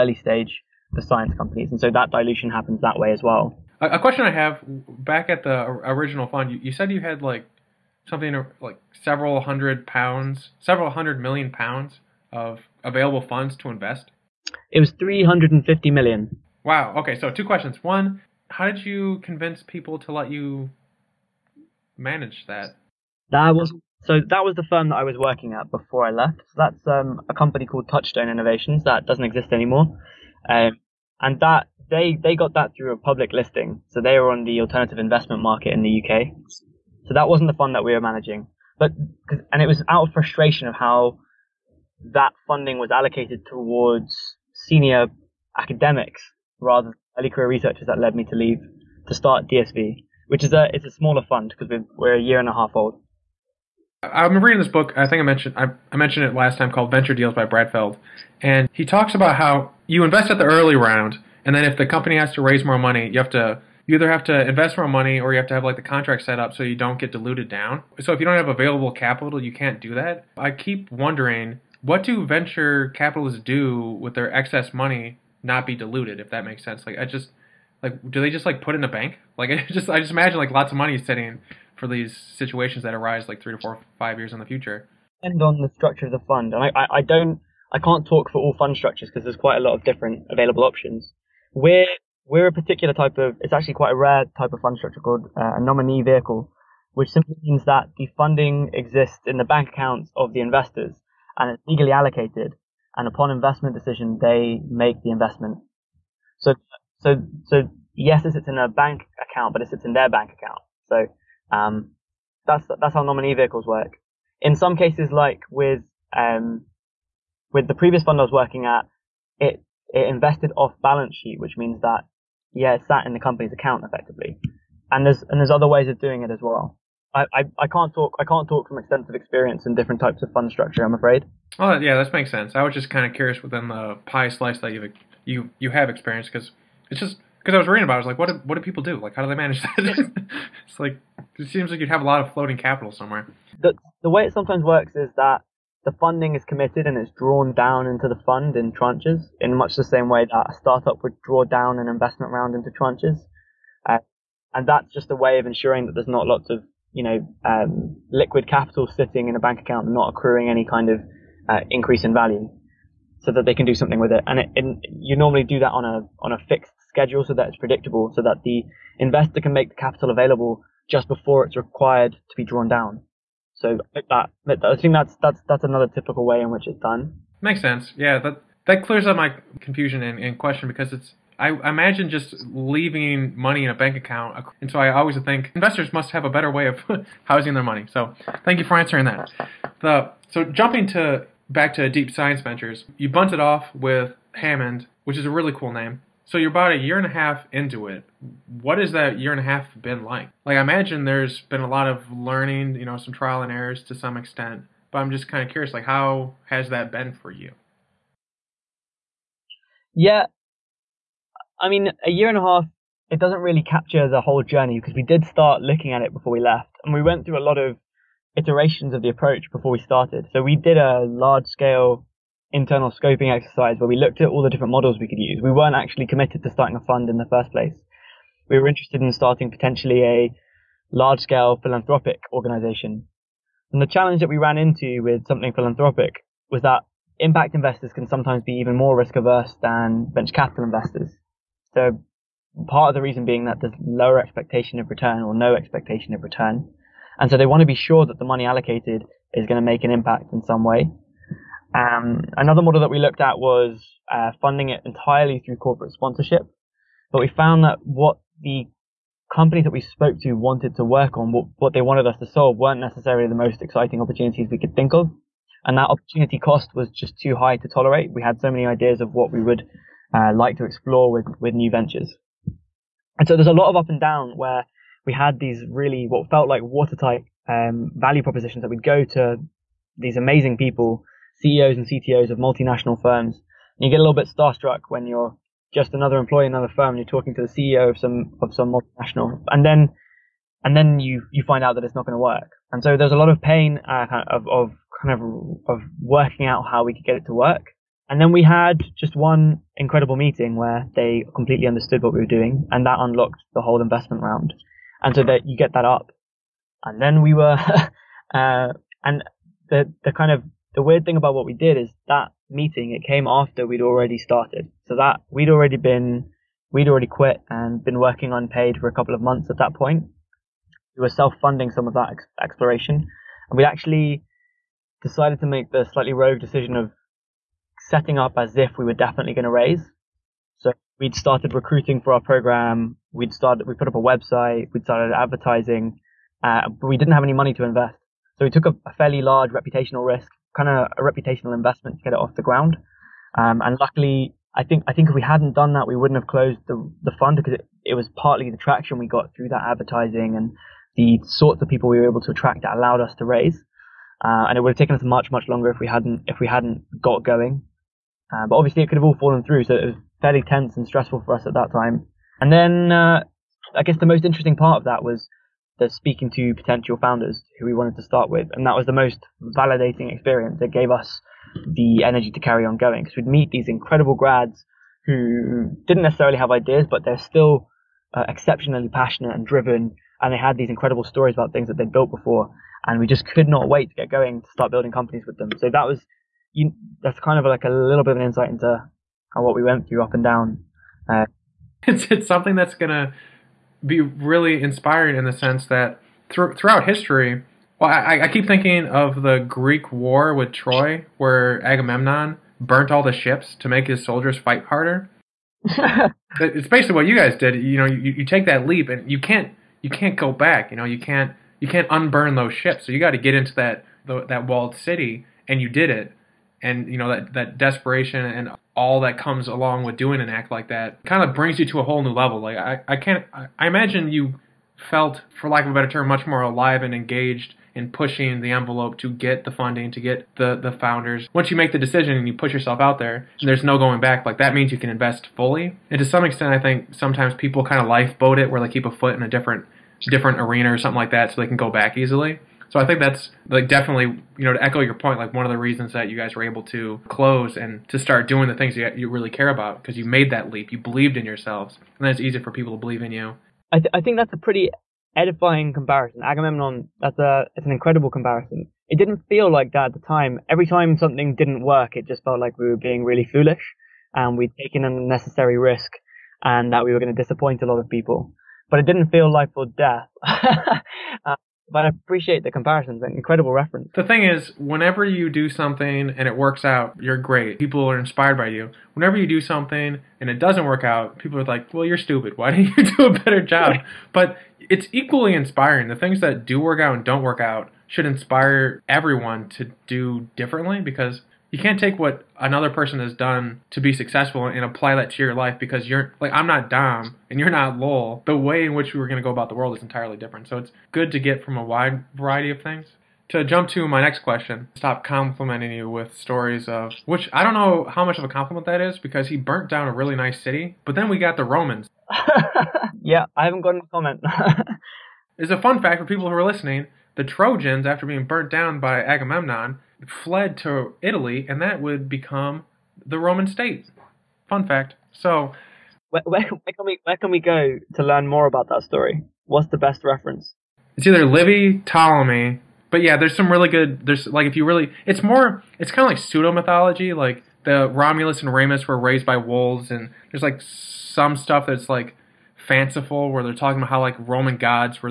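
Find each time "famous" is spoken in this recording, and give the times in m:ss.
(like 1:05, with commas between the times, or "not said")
not said.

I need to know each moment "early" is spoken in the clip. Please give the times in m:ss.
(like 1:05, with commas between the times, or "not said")
0:47, 1:00.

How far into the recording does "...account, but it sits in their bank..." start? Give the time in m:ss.
1:49.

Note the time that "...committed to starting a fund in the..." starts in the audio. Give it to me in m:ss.
3:46.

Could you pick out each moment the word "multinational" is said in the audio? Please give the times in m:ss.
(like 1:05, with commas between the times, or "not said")
4:42, 4:48.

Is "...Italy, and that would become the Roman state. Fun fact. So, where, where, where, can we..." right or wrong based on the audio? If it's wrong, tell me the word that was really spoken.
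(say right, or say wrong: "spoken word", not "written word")
right.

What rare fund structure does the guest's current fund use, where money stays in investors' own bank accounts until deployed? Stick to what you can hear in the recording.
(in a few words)
nominee vehicle.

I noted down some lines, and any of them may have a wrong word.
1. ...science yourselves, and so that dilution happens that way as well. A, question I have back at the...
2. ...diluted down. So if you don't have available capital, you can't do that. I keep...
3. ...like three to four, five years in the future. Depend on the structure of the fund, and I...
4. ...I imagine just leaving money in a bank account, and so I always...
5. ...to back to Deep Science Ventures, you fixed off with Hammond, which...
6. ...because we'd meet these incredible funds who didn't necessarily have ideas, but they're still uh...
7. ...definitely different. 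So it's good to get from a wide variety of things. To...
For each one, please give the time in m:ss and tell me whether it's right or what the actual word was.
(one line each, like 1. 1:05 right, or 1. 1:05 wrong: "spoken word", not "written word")
1. 0:01 wrong: "companies", not "yourselves"
2. 1:07 right
3. 1:23 right
4. 3:01 right
5. 3:10 wrong: "bunted", not "fixed"
6. 6:13 wrong: "grads", not "funds"
7. 8:19 wrong: "entirely", not "definitely".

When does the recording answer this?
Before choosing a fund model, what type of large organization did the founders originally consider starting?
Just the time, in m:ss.
3:51.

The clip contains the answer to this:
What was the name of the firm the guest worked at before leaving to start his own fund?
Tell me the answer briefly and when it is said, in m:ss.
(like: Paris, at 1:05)
Touchstone Innovations, at 0:27.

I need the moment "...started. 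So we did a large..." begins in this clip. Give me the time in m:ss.
3:39.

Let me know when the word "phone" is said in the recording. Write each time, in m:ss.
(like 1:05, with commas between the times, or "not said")
not said.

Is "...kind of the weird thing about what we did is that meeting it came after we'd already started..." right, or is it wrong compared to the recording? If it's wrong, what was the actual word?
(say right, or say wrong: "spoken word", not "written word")
right.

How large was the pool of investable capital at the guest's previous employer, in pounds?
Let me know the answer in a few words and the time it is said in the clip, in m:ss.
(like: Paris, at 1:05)
350 million, at 0:14.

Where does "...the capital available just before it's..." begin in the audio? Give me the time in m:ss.
2:49.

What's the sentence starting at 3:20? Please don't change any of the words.
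Like I imagine there's been a lot of learning, you know, some trial and errors to some extent.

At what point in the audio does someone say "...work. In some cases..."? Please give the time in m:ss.
1:53.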